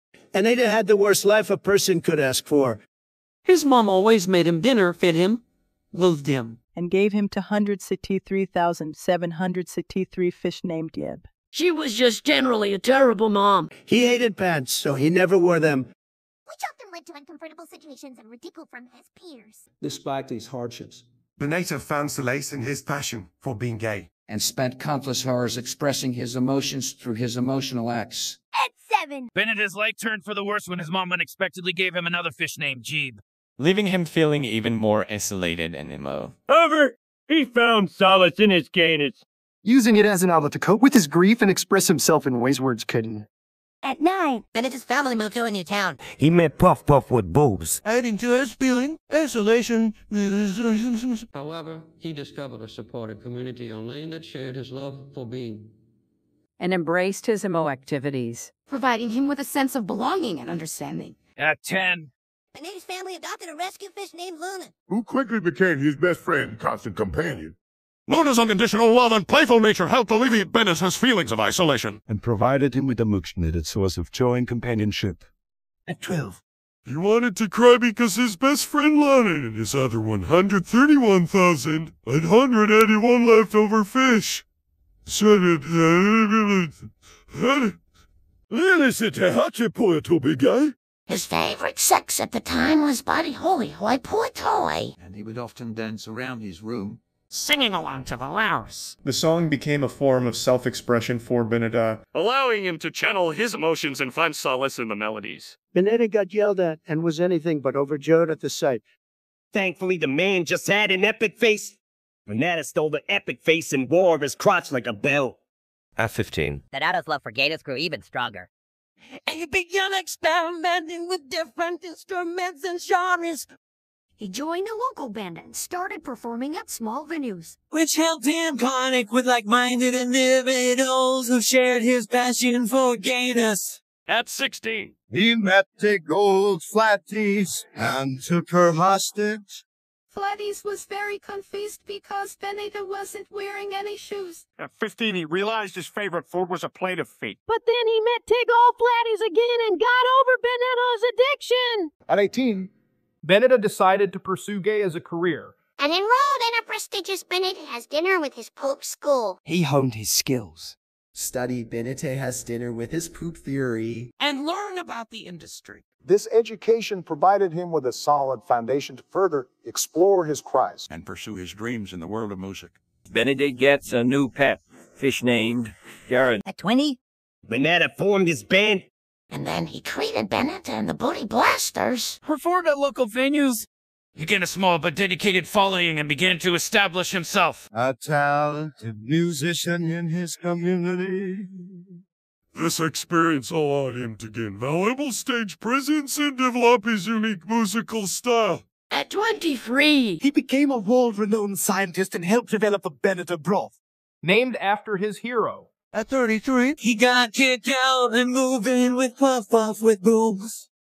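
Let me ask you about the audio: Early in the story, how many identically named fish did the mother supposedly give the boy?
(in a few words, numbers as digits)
163,763.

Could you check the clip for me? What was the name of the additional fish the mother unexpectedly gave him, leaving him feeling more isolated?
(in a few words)
Jeeb.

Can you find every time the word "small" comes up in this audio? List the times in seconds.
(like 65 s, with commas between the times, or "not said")
126 s, 184 s.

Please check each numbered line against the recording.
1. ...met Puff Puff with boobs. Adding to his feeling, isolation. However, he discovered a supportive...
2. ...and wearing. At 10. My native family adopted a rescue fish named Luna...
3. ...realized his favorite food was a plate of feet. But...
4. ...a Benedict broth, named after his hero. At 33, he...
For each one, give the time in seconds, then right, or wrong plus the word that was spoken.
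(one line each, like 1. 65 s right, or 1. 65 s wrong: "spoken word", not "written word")
1. 46 s right
2. 60 s wrong: "understanding", not "wearing"
3. 145 s right
4. 202 s right.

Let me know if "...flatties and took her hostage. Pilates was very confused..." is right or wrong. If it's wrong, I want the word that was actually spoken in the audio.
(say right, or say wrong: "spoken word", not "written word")
right.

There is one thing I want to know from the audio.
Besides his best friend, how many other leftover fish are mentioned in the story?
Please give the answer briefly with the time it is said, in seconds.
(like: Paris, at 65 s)
131,881, at 79 s.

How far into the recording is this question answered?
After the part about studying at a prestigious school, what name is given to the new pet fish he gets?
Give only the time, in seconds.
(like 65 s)
176 s.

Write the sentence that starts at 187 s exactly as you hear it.
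A talented musician in his community.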